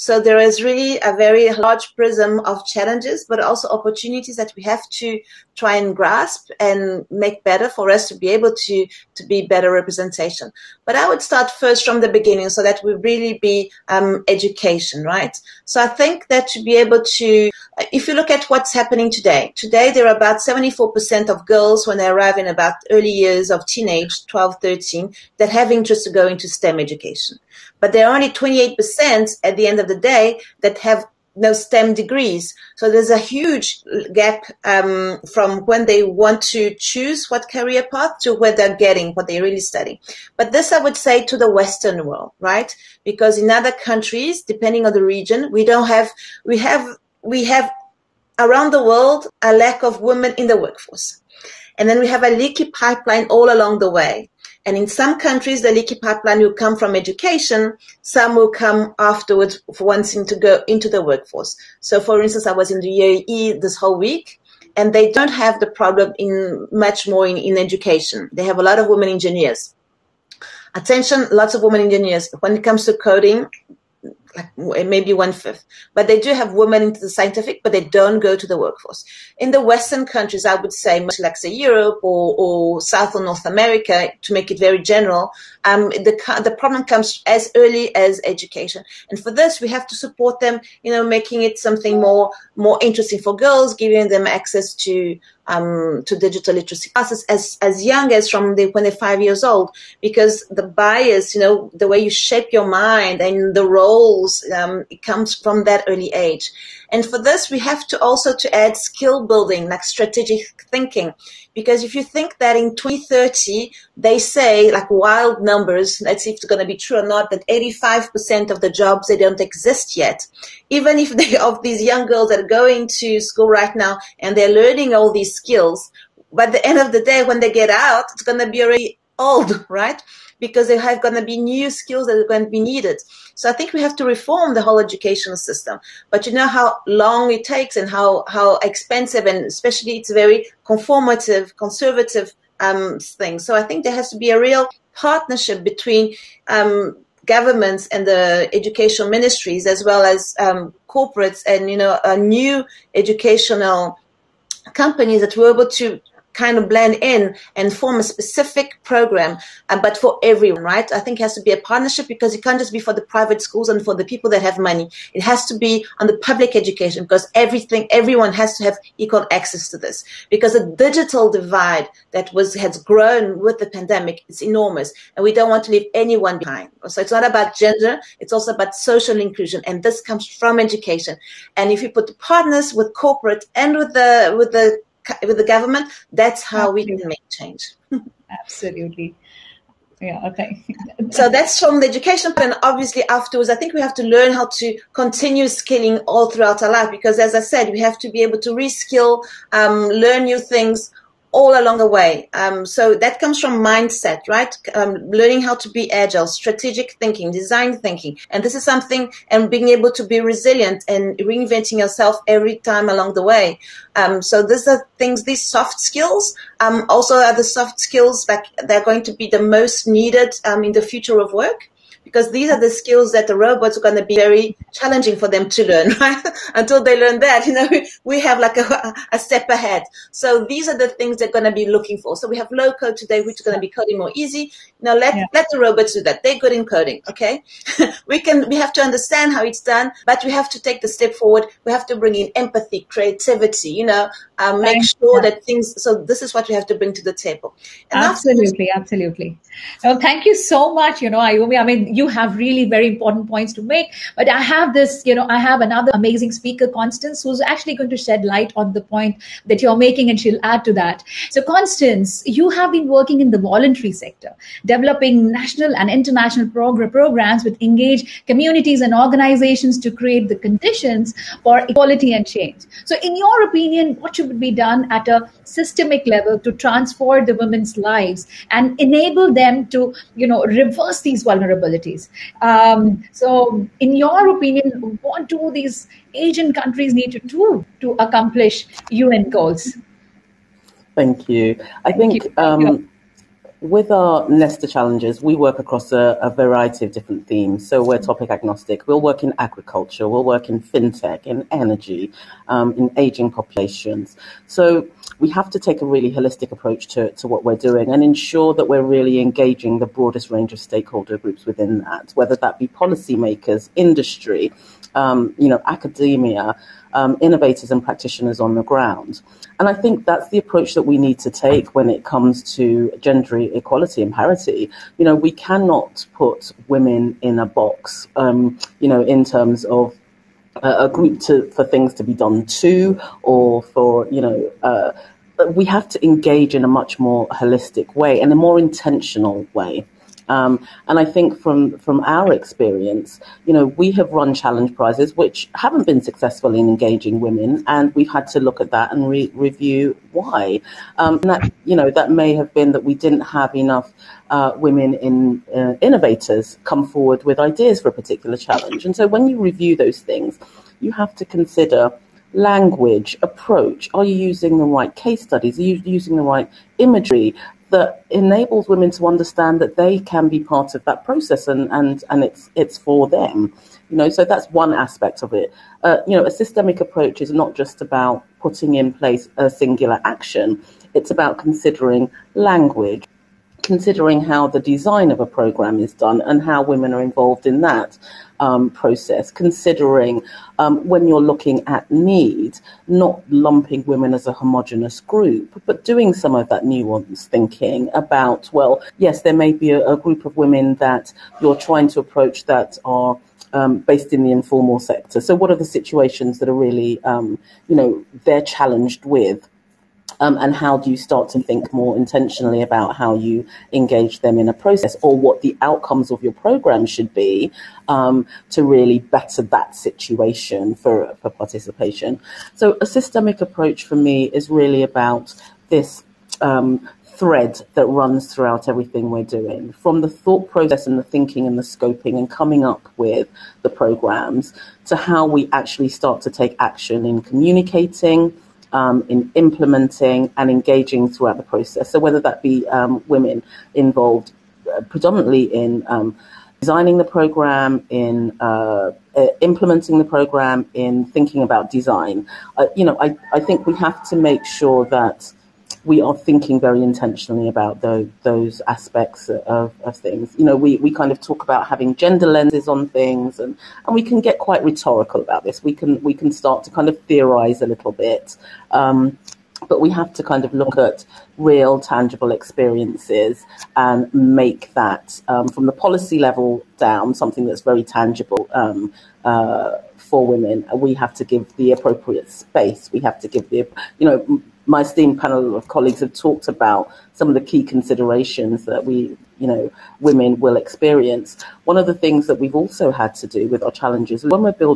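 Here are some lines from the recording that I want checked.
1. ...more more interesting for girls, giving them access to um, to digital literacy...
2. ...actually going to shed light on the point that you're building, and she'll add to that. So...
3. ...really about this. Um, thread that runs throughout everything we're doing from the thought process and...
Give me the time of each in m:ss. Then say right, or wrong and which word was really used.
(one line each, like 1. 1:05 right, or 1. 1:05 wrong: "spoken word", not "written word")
1. 1:32 right
2. 4:17 wrong: "making", not "building"
3. 7:04 right.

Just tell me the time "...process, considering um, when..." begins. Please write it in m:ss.
6:28.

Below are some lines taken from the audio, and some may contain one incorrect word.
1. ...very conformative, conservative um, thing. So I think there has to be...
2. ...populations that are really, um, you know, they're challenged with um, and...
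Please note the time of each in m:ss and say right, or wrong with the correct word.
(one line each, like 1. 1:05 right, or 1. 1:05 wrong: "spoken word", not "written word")
1. 2:20 right
2. 6:45 wrong: "situations", not "populations".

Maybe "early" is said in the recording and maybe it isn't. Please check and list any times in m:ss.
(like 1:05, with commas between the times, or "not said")
0:22, 1:27, 1:45.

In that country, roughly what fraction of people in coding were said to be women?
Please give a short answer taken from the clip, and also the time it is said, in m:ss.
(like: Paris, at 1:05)
one fifth, at 1:15.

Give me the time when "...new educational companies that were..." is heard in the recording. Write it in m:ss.
2:32.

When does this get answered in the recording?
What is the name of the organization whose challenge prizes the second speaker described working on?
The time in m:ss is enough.
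4:54.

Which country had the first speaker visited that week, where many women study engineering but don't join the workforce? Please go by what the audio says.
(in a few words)
UAE.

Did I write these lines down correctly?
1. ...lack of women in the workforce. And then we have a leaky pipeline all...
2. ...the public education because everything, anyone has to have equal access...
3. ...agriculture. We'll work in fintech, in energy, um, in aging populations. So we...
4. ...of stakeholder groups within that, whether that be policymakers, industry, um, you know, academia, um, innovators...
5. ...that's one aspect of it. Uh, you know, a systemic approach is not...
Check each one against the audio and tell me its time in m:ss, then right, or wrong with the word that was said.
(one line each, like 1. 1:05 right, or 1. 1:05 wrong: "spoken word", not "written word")
1. 0:49 right
2. 2:46 wrong: "everyone", not "anyone"
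3. 4:59 right
4. 5:10 right
5. 6:14 right.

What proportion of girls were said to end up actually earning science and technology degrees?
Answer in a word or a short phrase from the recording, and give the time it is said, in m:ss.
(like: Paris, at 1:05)
28%, at 0:28.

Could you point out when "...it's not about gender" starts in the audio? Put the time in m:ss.
2:57.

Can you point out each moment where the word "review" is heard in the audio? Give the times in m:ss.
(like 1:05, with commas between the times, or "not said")
5:49, 5:59.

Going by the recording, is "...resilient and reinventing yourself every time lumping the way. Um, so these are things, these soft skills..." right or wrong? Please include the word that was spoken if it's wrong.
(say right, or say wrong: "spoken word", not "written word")
wrong: "along", not "lumping".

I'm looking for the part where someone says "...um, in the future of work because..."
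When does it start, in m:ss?
3:40.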